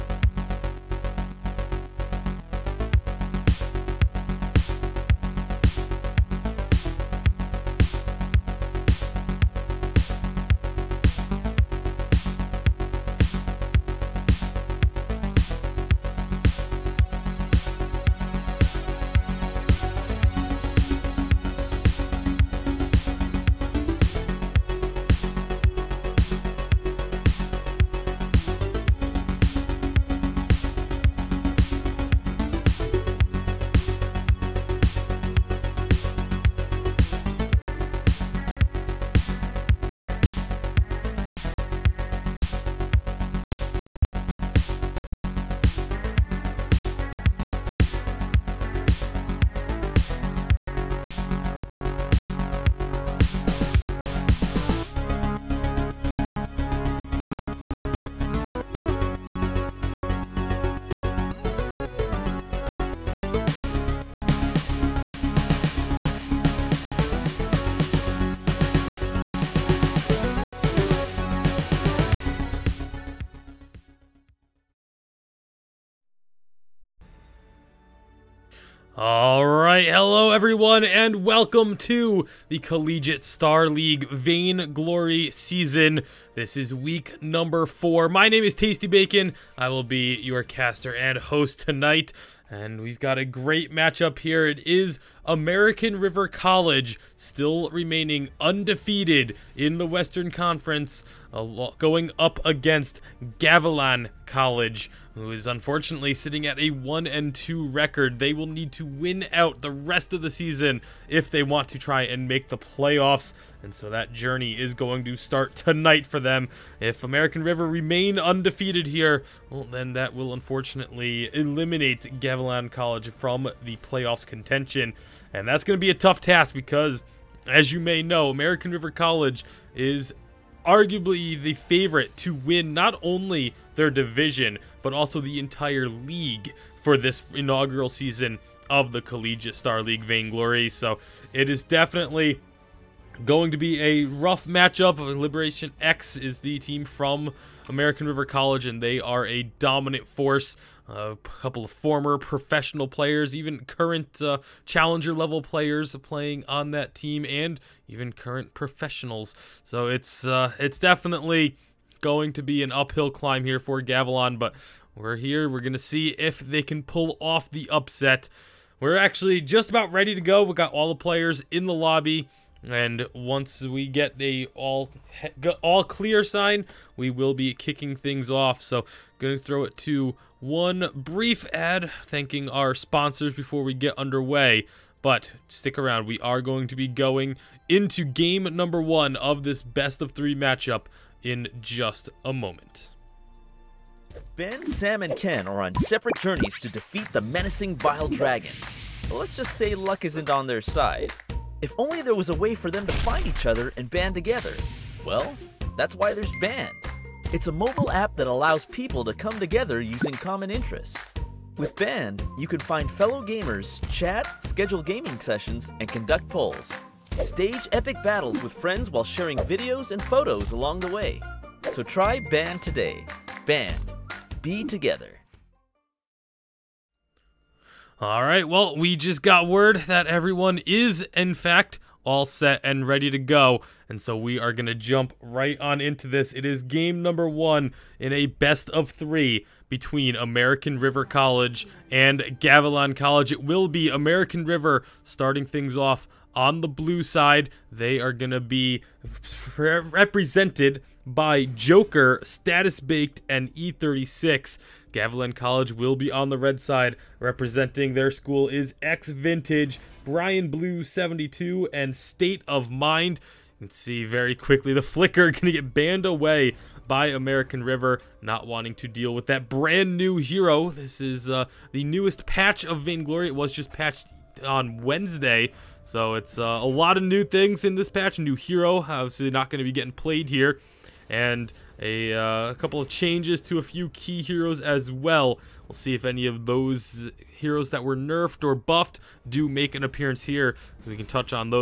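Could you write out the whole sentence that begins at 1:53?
And so that journey is going to start tonight for them.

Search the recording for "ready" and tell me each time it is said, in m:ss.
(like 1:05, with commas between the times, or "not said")
2:49, 3:52.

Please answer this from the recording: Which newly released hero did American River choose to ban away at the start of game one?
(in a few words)
Flicker.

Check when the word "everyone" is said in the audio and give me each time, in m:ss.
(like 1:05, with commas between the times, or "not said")
1:20, 3:50.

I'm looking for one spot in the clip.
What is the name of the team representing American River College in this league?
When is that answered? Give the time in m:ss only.
2:25.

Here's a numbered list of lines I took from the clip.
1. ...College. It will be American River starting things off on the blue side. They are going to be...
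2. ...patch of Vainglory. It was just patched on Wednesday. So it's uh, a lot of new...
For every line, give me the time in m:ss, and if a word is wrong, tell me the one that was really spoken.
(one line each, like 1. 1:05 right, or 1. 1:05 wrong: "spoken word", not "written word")
1. 4:02 right
2. 4:32 right.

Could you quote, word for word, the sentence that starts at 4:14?
Gavilan College will be on the red side.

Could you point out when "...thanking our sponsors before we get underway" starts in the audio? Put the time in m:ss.
3:02.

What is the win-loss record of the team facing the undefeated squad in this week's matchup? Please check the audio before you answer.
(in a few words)
1 and 2.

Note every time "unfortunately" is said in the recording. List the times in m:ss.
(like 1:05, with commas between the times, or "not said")
1:45, 2:00.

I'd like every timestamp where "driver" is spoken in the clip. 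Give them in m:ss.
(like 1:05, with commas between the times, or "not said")
not said.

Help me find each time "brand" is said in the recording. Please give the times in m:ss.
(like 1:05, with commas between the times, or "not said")
4:29.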